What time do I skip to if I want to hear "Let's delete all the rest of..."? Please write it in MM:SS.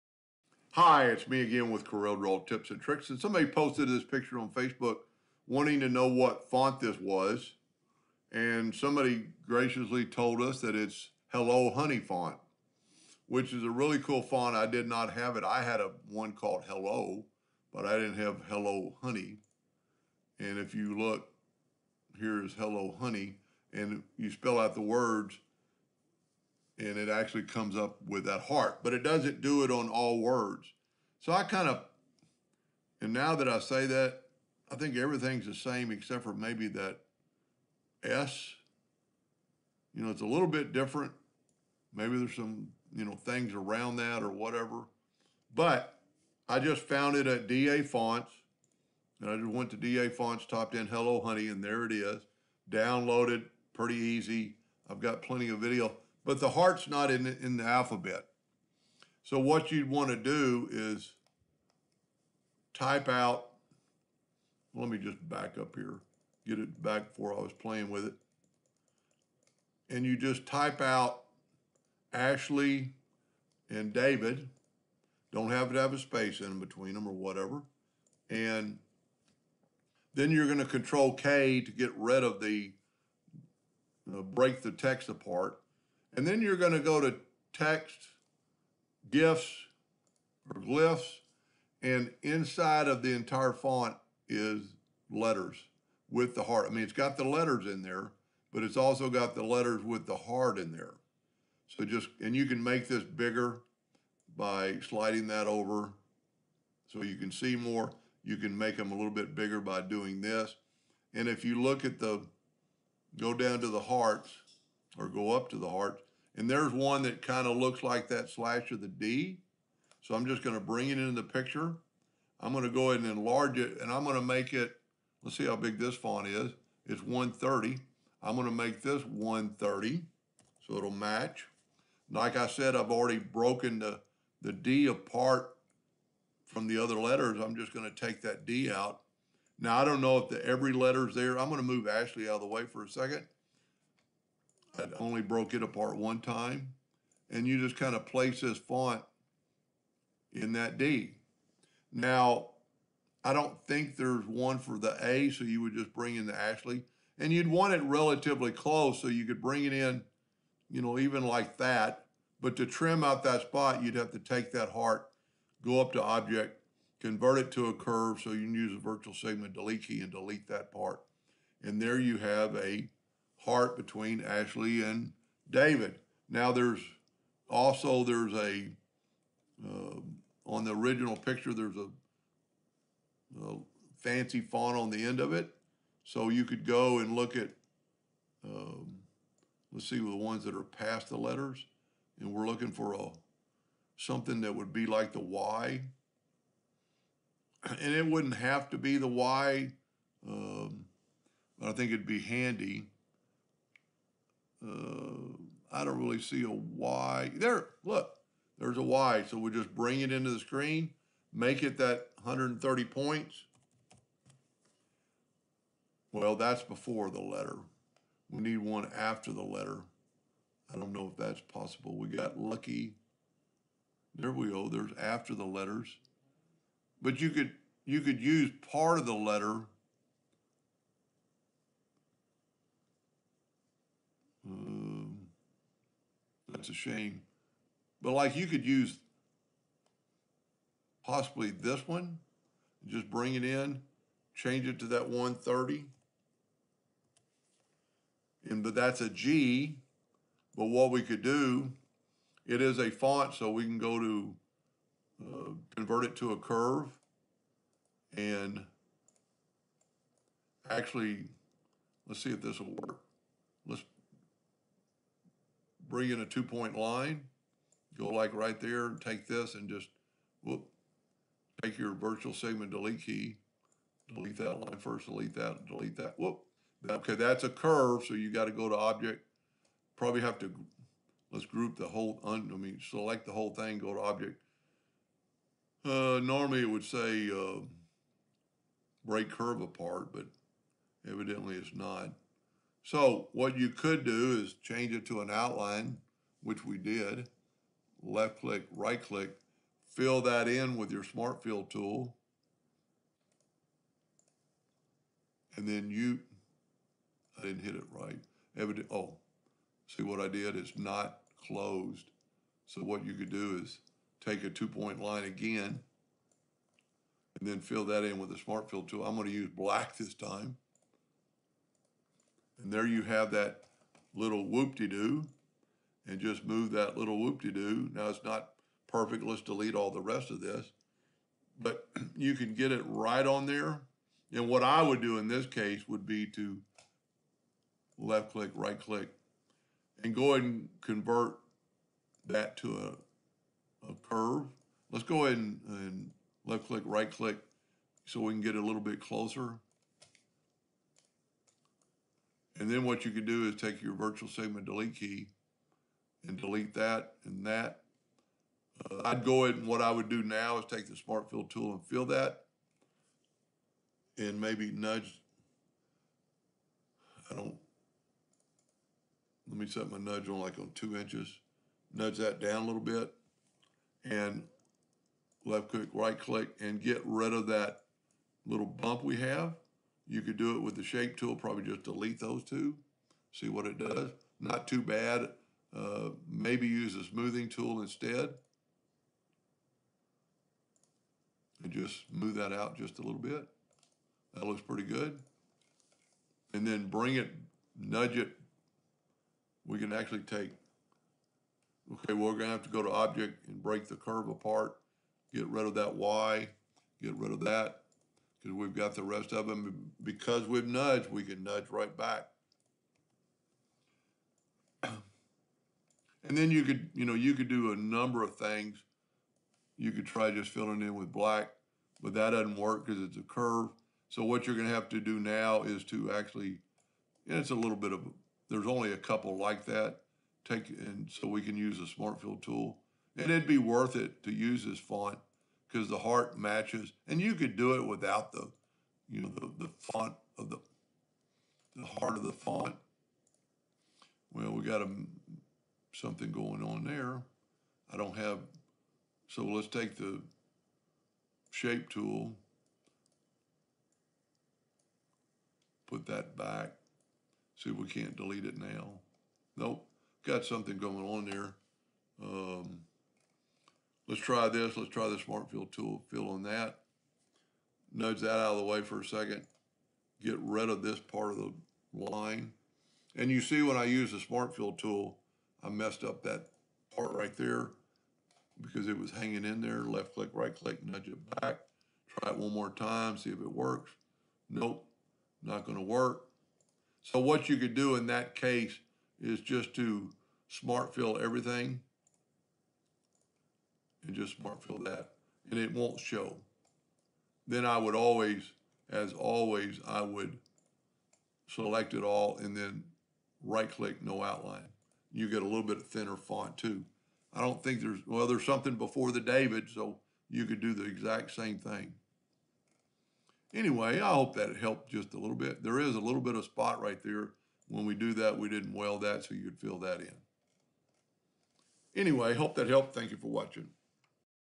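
05:29.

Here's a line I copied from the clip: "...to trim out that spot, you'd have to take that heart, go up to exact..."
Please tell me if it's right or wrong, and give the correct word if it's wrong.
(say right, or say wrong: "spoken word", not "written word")
wrong: "object", not "exact".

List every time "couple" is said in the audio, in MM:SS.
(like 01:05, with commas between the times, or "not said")
07:08.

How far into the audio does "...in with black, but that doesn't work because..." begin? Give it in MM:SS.
07:00.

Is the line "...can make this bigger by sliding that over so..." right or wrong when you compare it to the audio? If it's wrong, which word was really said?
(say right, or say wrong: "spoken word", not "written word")
right.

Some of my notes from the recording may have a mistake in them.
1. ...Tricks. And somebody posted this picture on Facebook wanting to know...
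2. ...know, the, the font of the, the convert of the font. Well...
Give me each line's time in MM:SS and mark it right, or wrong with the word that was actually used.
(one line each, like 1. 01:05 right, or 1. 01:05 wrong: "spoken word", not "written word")
1. 00:02 right
2. 07:19 wrong: "heart", not "convert".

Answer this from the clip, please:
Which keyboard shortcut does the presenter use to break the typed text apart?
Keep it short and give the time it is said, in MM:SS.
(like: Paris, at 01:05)
Control K, at 01:20.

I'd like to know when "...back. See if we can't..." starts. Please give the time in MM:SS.
07:36.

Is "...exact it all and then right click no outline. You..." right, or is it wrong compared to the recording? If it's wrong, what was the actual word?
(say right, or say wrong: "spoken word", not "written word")
wrong: "select", not "exact".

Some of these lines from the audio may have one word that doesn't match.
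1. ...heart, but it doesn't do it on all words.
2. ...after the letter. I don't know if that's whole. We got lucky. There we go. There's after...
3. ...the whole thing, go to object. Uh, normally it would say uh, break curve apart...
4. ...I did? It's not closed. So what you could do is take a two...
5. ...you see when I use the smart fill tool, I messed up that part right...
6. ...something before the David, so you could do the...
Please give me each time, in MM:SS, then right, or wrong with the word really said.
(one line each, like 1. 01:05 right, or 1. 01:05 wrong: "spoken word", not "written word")
1. 00:28 right
2. 03:38 wrong: "possible", not "whole"
3. 04:43 right
4. 05:10 right
5. 07:53 right
6. 08:28 right.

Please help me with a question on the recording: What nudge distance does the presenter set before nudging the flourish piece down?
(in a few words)
2 inches.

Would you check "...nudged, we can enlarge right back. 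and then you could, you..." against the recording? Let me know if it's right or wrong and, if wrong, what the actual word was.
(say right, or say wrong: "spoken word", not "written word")
wrong: "nudge", not "enlarge".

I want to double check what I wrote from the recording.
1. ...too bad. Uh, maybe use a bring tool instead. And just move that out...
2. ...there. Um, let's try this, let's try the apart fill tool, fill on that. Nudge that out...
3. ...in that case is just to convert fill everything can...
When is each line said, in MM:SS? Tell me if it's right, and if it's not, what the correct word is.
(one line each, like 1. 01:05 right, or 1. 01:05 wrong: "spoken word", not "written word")
1. 06:24 wrong: "smoothing", not "bring"
2. 07:41 wrong: "smart", not "apart"
3. 08:07 wrong: "smart", not "convert".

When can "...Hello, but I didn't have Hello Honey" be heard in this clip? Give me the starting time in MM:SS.
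00:16.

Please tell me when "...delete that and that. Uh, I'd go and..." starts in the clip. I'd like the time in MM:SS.
05:56.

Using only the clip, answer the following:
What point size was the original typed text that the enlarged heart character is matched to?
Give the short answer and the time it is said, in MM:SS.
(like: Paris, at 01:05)
130, at 02:06.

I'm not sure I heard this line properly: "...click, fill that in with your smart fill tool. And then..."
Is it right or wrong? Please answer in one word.
right.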